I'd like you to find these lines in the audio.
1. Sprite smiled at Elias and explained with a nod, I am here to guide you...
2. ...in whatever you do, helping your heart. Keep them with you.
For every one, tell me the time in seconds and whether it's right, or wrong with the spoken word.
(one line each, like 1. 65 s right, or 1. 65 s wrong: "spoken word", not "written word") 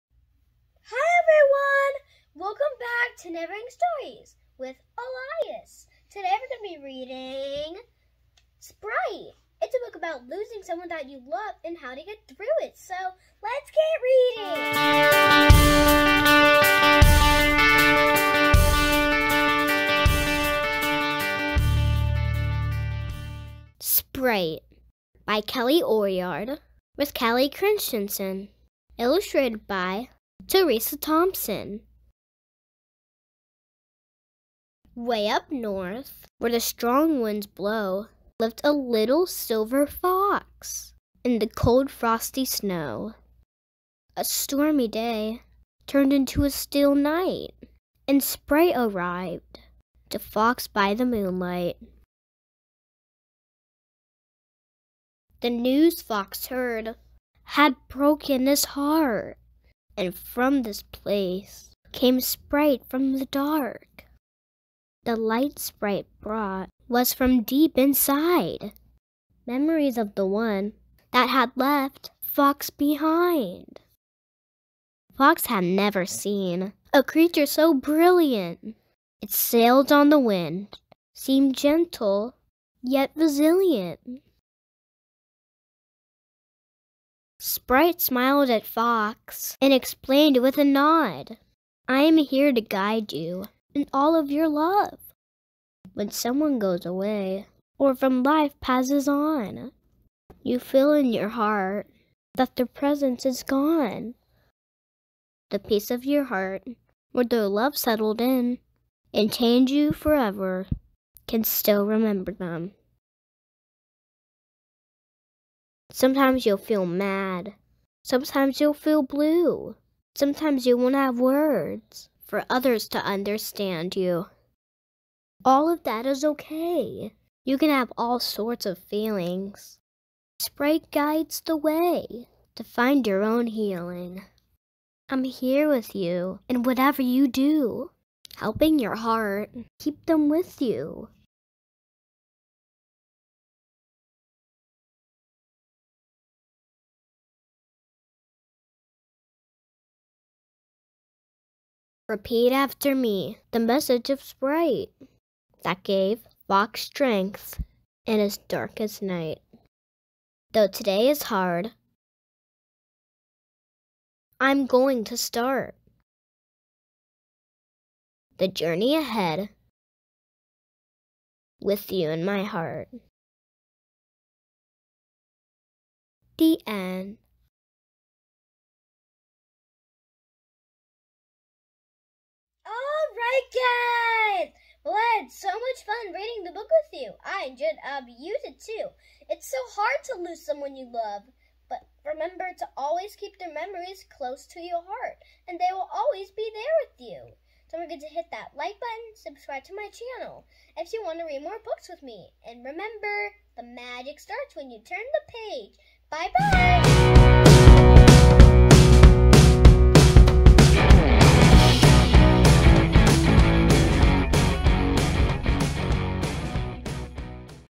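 1. 87 s wrong: "Fox", not "Elias"
2. 136 s right.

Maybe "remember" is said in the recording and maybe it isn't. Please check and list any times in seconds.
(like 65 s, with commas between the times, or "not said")
111 s, 192 s, 202 s.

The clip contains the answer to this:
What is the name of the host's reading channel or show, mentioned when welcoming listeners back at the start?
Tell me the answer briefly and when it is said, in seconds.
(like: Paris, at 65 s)
Neverending Stories, at 3 s.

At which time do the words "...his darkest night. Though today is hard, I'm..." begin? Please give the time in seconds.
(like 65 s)
158 s.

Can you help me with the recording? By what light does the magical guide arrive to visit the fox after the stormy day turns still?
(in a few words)
moonlight.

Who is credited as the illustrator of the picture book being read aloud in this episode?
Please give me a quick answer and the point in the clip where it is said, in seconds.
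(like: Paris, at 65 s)
Teresa Thompson, at 30 s.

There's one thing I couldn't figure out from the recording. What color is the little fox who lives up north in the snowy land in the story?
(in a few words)
silver.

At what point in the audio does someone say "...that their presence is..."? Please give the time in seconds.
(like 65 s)
102 s.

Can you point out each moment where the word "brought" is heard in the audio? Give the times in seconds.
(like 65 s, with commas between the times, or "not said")
66 s.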